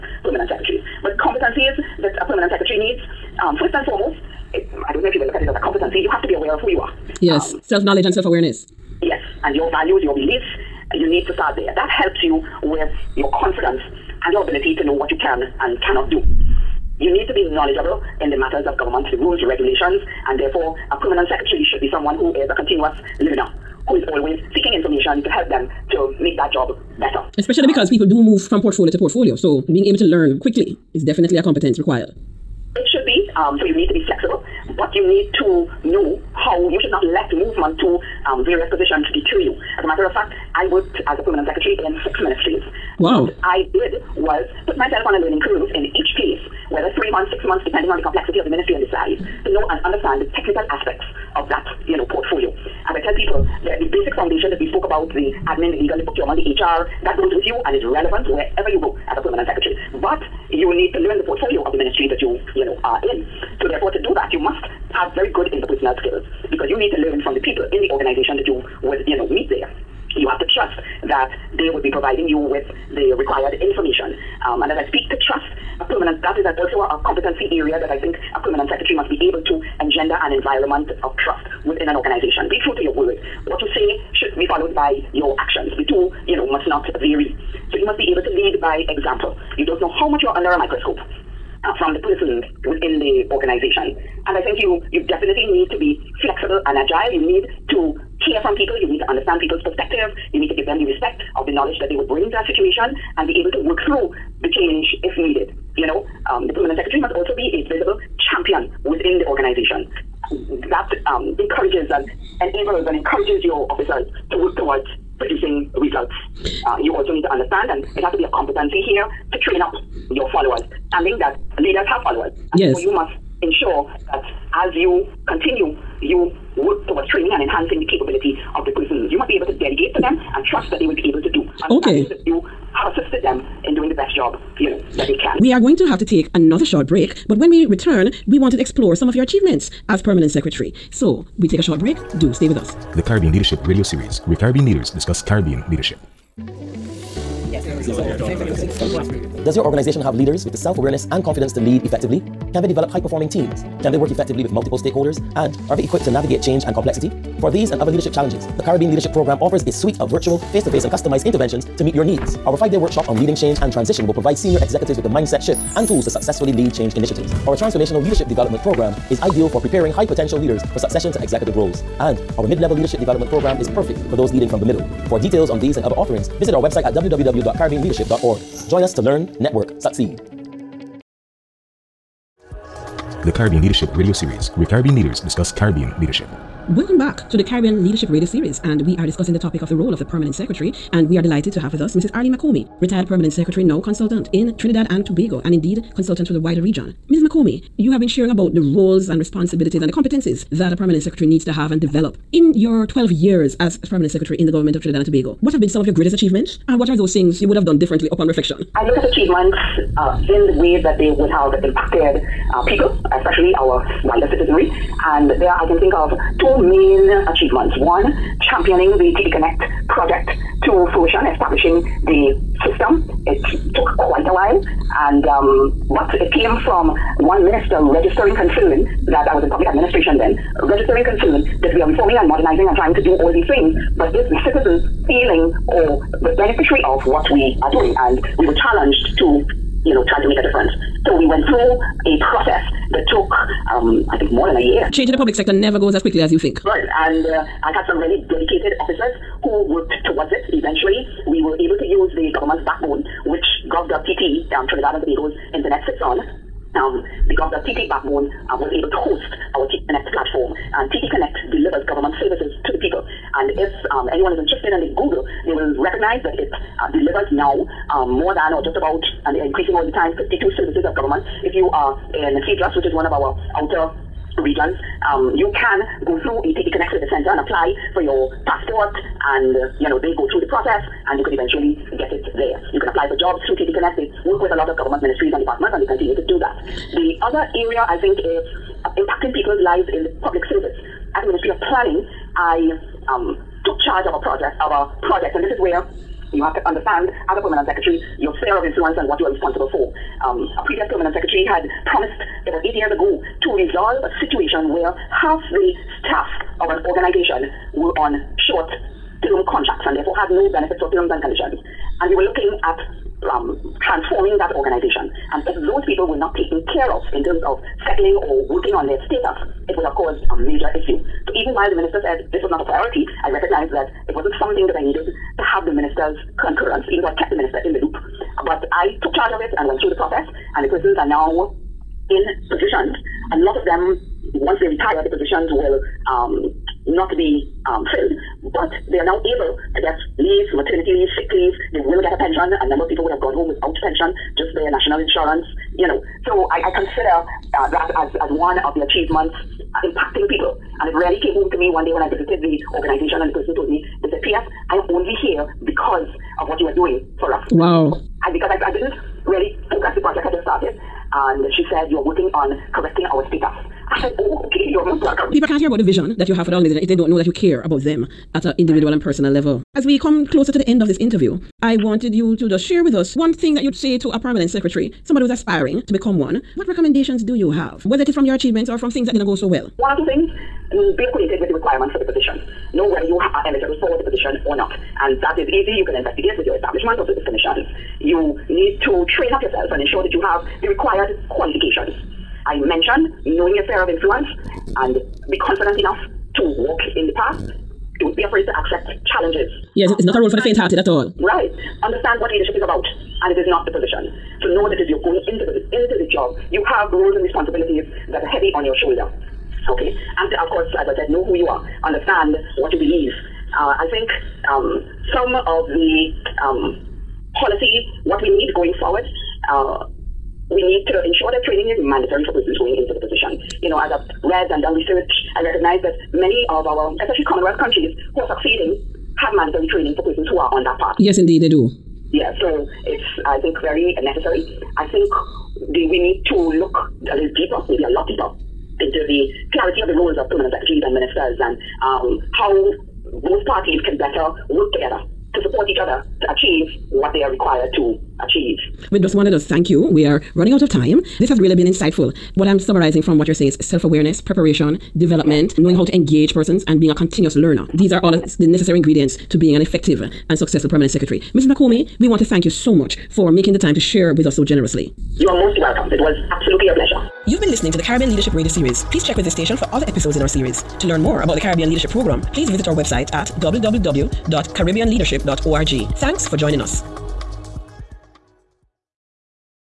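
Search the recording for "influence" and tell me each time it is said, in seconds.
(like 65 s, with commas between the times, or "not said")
298 s, 393 s.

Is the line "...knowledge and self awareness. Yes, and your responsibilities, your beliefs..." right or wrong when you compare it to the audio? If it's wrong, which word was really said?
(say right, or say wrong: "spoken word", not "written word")
wrong: "values", not "responsibilities".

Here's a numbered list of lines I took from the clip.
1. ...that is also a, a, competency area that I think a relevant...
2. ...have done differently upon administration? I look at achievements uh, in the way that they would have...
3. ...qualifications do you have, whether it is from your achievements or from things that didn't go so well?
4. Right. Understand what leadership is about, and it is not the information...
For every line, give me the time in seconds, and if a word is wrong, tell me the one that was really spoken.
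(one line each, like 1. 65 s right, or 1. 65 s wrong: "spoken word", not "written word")
1. 76 s wrong: "permanent", not "relevant"
2. 207 s wrong: "reflection", not "administration"
3. 376 s wrong: "recommendations", not "qualifications"
4. 401 s wrong: "position", not "information".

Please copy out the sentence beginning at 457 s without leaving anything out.
These are all the necessary ingredients to being an effective and successful permanent secretary.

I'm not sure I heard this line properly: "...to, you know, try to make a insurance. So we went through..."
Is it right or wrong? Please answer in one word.
wrong.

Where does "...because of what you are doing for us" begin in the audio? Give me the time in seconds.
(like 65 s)
355 s.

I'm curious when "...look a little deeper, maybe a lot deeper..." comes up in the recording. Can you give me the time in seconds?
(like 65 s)
436 s.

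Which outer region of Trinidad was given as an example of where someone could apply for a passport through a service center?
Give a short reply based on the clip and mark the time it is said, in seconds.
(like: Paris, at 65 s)
Cedros, at 272 s.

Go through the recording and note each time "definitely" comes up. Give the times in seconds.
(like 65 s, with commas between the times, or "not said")
31 s, 95 s.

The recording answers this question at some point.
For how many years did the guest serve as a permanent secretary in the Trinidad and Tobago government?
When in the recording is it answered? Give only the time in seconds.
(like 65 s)
202 s.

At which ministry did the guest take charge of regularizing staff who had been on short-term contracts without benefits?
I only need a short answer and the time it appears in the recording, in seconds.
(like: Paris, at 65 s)
Ministry of Planning, at 291 s.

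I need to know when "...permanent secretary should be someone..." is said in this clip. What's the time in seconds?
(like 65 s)
20 s.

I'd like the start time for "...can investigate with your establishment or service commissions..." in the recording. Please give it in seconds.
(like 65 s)
385 s.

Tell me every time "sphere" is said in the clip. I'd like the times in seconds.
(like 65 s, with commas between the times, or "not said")
298 s, 393 s.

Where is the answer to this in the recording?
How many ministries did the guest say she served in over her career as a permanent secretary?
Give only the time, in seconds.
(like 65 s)
42 s.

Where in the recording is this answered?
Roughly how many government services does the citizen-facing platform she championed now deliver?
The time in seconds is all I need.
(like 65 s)
270 s.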